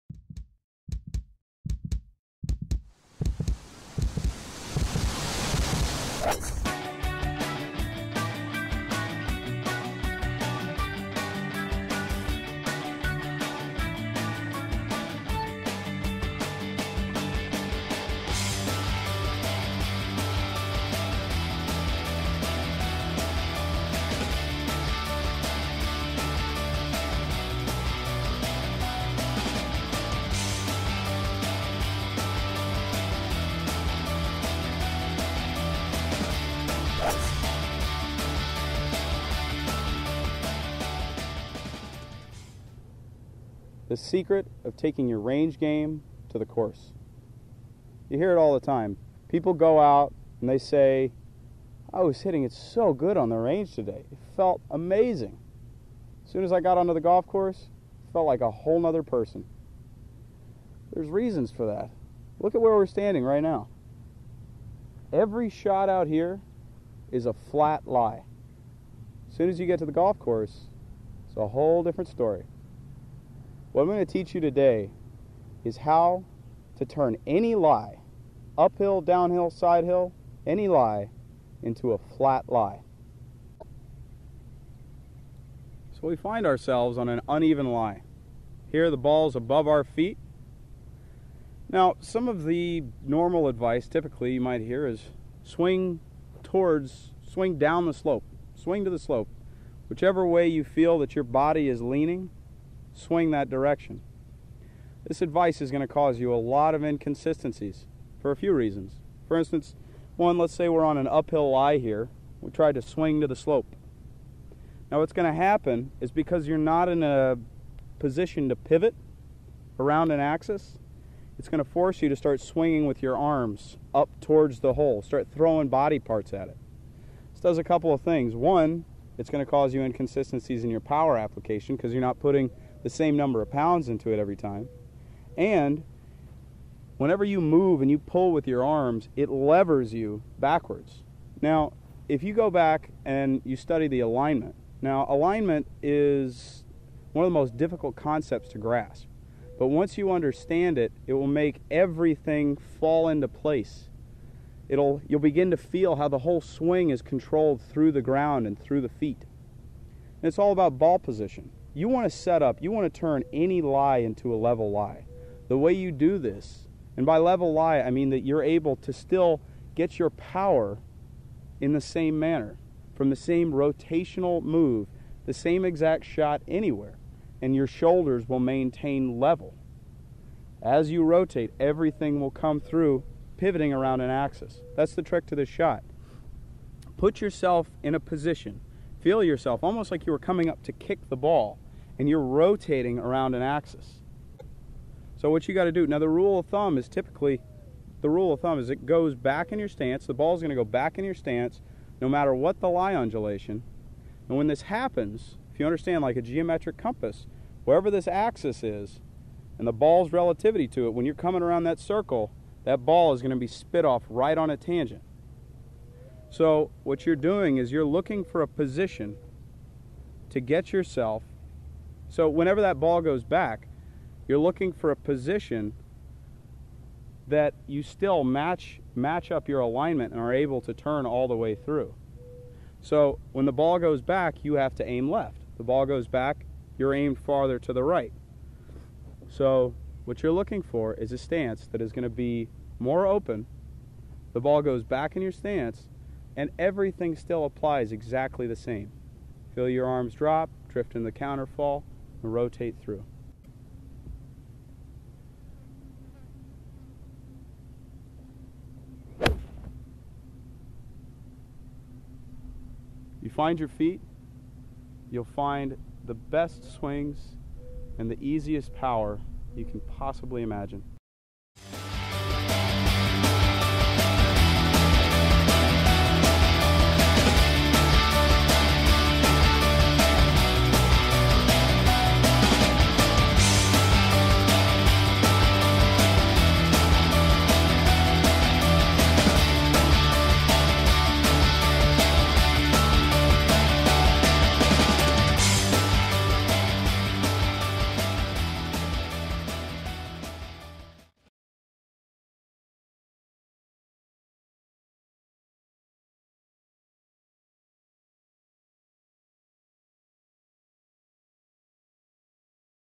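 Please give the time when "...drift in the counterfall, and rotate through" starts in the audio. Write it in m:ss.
4:10.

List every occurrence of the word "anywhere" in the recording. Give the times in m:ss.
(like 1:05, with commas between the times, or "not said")
2:56.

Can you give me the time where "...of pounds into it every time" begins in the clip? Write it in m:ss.
2:13.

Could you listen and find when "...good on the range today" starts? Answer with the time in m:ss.
0:52.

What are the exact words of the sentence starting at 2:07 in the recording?
This does a couple of things.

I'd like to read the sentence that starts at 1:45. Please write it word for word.
This advice is going to cause you a lot of inconsistencies for a few reasons.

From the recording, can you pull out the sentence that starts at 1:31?
Now, some of the normal advice typically you might hear is swing towards, swing down the slope, swing to the slope.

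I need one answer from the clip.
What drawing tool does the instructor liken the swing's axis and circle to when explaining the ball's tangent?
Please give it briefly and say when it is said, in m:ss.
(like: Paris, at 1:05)
A geometric compass, at 3:26.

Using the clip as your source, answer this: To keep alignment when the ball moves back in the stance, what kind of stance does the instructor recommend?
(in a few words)
More open.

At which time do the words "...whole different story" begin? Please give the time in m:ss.
1:11.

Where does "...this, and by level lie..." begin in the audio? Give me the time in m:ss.
2:46.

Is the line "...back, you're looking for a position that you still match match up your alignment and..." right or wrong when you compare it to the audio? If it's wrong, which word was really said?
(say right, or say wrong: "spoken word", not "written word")
right.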